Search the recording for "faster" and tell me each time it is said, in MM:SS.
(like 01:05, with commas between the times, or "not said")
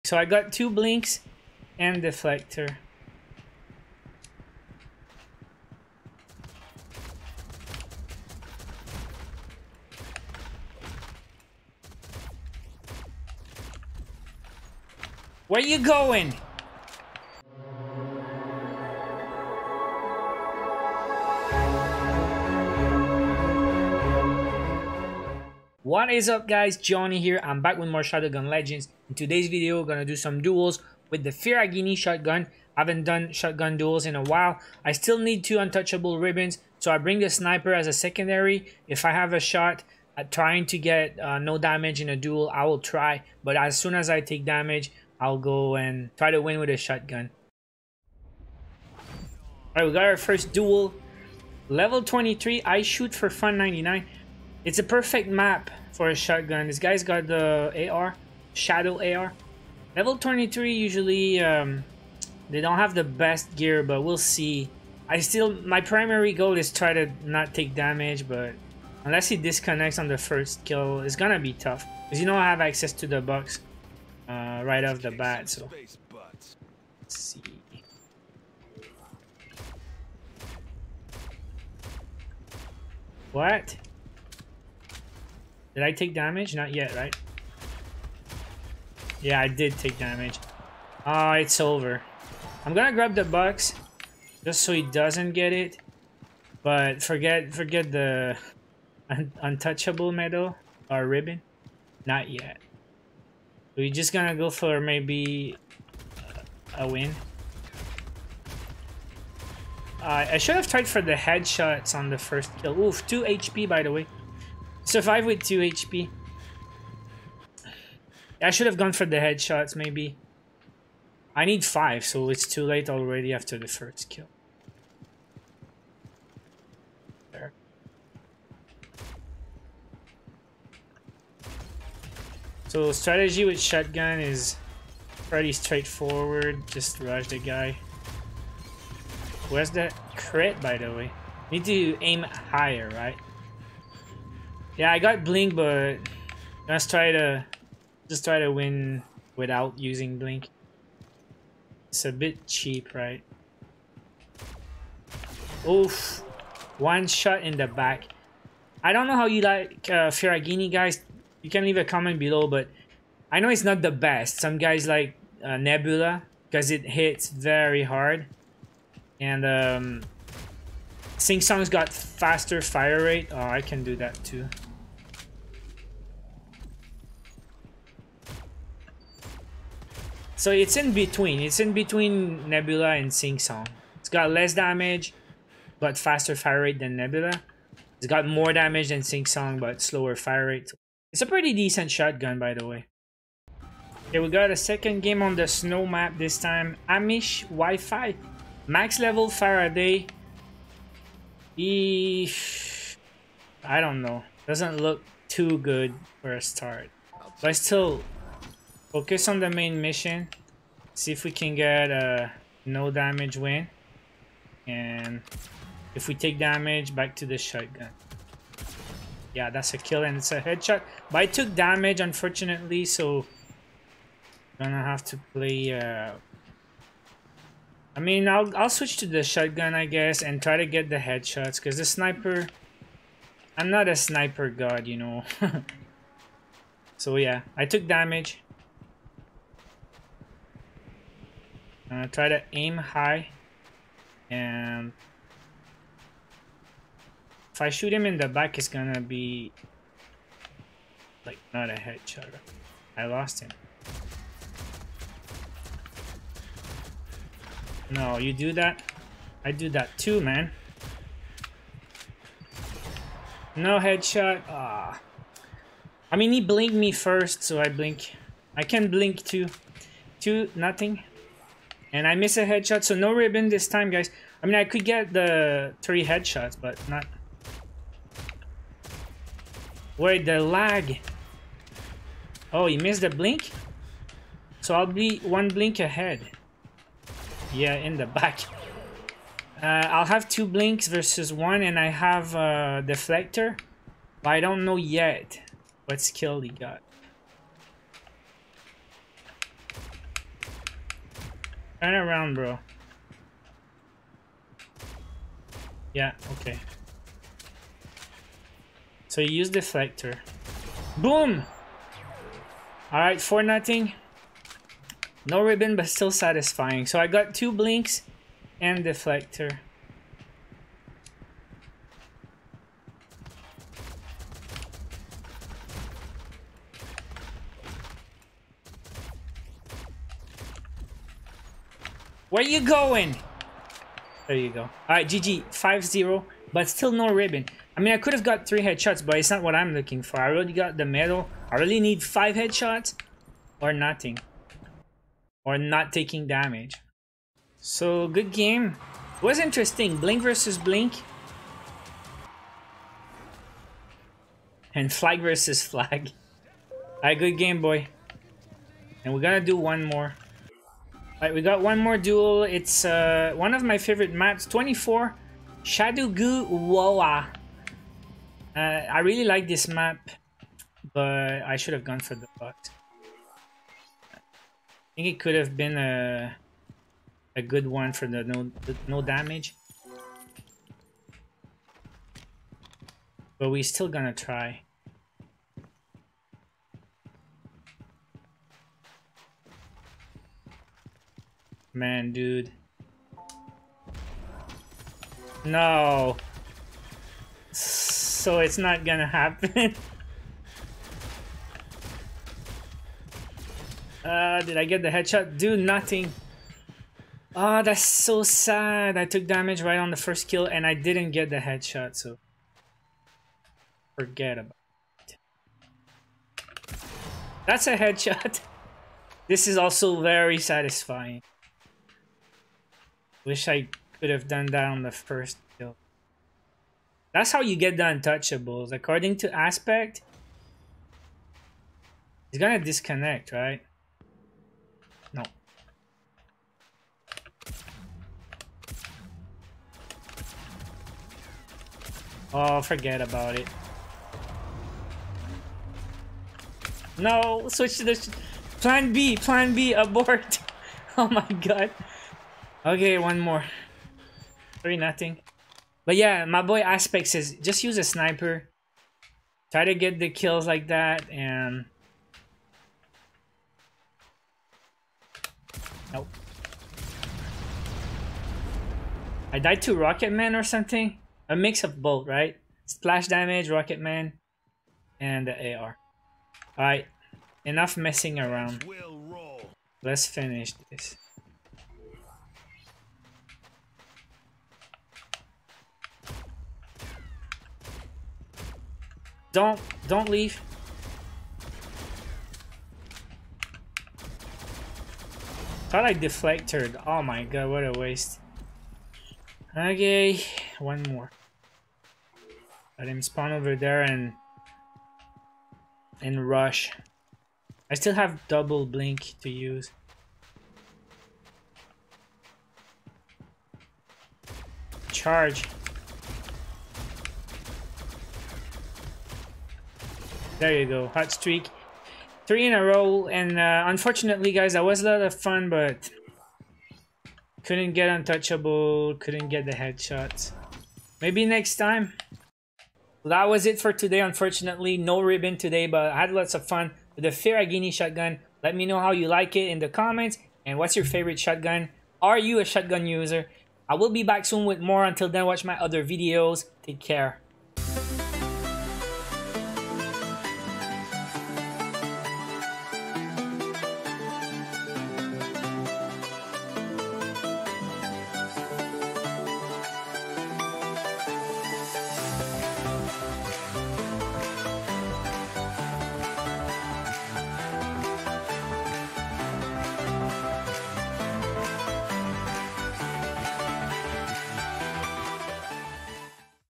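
02:51, 03:05.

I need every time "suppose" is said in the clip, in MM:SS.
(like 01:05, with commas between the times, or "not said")
not said.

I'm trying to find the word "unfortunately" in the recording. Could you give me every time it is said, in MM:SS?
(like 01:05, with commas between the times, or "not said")
03:41, 08:43, 08:53.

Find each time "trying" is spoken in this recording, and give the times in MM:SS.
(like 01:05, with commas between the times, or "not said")
00:40.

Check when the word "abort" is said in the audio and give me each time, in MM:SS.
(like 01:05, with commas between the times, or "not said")
07:29.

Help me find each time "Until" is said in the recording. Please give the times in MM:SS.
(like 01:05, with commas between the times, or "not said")
09:04.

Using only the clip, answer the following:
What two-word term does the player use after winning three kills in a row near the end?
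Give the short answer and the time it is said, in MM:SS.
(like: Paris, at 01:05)
Hot streak, at 08:40.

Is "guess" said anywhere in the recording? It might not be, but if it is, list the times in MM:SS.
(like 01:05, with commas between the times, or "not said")
03:49.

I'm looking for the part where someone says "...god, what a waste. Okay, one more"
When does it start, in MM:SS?
08:17.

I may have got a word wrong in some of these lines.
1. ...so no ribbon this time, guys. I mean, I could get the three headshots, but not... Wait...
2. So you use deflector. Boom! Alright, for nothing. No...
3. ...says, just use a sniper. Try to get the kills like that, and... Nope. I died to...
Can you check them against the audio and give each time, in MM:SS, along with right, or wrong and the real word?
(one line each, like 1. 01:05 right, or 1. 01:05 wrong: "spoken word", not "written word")
1. 04:32 right
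2. 05:09 right
3. 07:37 right.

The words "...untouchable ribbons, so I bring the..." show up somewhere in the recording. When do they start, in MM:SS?
00:35.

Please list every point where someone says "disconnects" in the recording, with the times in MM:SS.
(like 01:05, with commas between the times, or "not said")
01:09, 07:12.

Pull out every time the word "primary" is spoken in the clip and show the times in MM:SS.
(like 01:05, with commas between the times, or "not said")
01:05.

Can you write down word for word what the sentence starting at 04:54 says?
But I don't know yet what skill he got.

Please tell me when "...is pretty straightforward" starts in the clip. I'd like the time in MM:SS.
02:14.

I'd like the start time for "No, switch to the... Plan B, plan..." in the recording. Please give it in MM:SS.
07:26.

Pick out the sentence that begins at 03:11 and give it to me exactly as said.
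It's a pretty decent shotgun, by the way.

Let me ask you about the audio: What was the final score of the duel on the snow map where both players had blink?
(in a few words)
5-0.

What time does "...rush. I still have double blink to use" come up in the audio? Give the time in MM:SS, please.
08:26.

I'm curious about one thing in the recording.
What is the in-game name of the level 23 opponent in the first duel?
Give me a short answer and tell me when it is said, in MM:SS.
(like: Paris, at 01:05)
I shoot for fun 99, at 00:52.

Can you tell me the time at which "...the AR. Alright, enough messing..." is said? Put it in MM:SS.
07:55.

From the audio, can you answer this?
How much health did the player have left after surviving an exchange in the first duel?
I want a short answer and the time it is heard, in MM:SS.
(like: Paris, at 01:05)
2 HP, at 01:54.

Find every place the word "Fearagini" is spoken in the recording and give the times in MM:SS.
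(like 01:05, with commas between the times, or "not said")
00:31, 02:40, 08:57.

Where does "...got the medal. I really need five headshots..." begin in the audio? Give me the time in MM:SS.
05:40.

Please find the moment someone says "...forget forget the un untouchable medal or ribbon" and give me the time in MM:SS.
01:37.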